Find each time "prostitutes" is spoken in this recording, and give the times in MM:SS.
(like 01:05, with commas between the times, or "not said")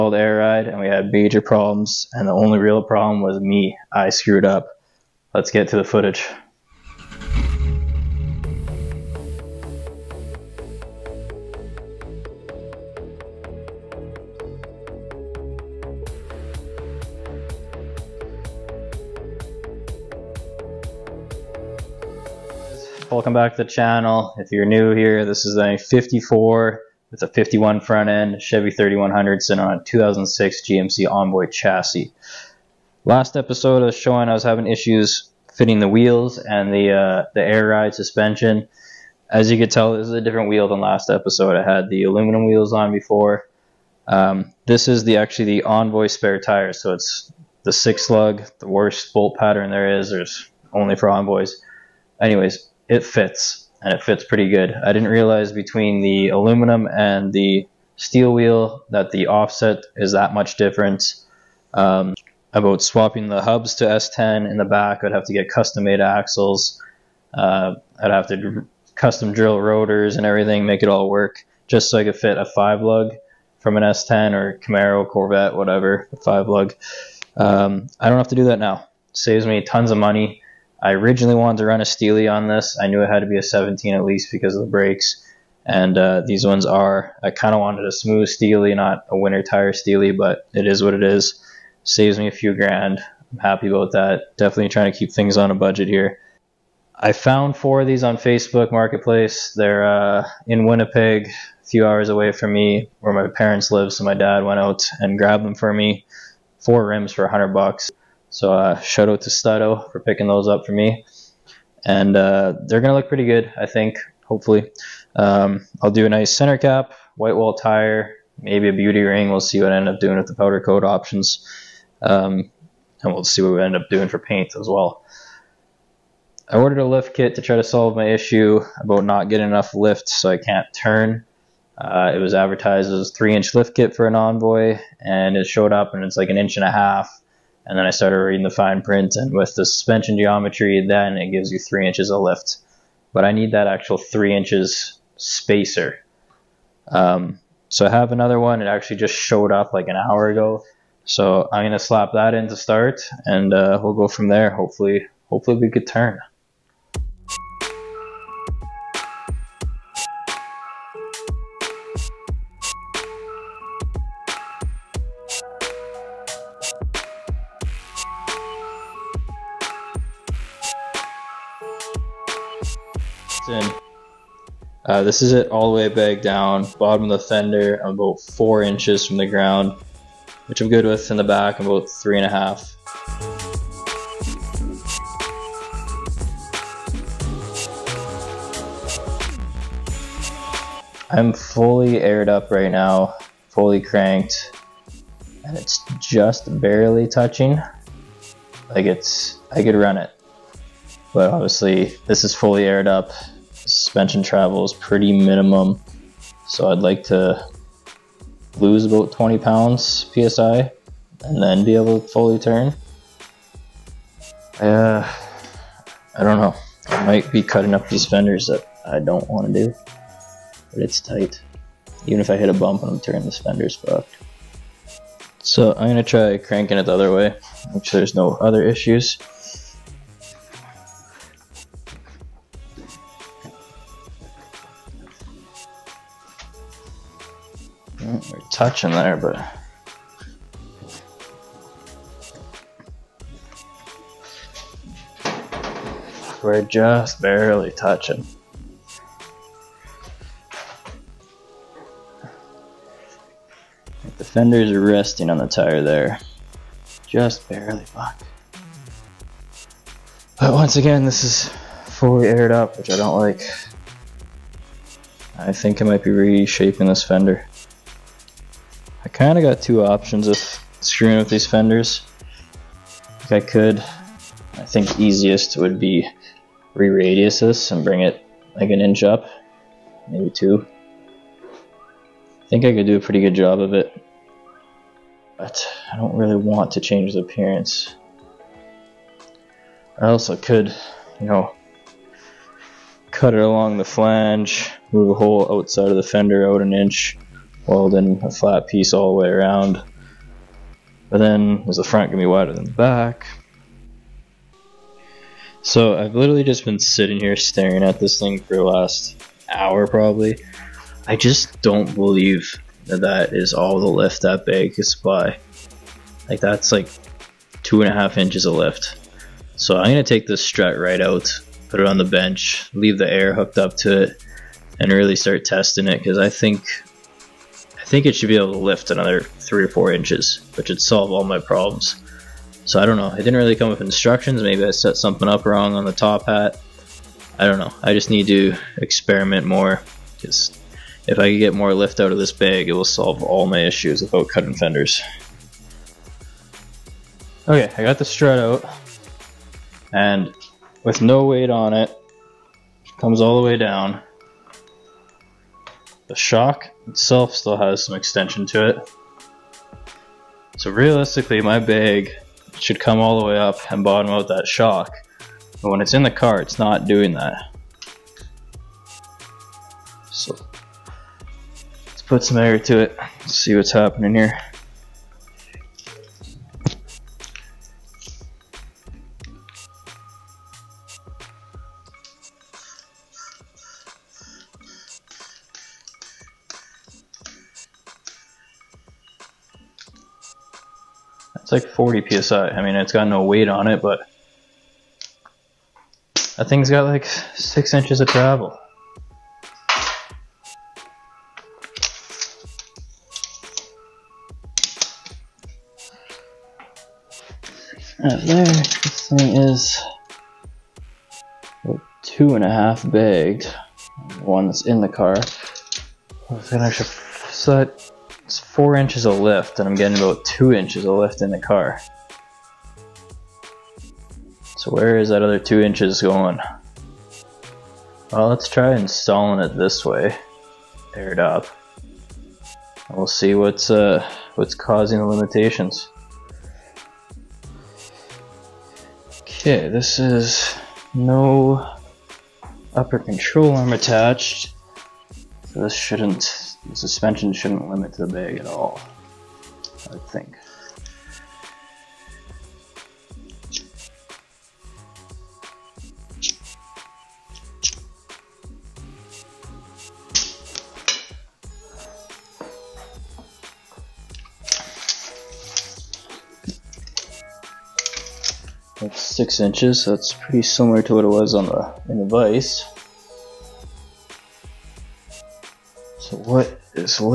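not said.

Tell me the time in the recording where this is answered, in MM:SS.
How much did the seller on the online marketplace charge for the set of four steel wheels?
01:47.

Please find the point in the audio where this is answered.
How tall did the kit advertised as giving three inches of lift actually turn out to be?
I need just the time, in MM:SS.
02:16.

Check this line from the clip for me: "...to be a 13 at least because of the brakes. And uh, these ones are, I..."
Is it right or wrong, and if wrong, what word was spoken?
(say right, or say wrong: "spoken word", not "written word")
wrong: "17", not "13".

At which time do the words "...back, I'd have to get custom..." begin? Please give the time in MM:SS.
01:04.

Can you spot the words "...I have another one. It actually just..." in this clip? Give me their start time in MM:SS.
02:27.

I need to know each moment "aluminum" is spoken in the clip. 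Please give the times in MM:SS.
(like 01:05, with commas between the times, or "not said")
00:42, 00:56.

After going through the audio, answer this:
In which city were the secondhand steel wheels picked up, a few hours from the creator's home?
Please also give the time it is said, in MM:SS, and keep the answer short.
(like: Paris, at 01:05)
Winnipeg, at 01:40.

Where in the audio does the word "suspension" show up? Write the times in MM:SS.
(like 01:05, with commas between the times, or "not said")
00:37, 02:19, 03:23, 07:26.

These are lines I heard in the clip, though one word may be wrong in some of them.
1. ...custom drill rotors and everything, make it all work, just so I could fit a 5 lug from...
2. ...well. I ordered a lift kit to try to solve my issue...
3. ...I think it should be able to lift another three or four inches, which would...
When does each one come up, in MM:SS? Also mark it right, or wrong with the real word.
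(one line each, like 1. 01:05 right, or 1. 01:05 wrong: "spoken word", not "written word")
1. 01:08 right
2. 02:04 right
3. 05:27 right.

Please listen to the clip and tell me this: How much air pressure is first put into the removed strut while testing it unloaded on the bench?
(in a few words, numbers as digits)
40 psi.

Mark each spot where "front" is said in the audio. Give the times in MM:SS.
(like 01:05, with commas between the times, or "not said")
00:27, 05:01.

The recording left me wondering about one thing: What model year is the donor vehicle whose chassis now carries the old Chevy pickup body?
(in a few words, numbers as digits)
2006.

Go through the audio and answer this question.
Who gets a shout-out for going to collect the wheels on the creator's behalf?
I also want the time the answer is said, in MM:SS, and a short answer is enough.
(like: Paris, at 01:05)
Stato, at 01:49.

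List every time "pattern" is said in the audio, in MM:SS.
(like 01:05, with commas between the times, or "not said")
00:49.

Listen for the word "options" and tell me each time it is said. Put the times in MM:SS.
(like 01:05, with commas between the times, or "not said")
02:00, 04:29.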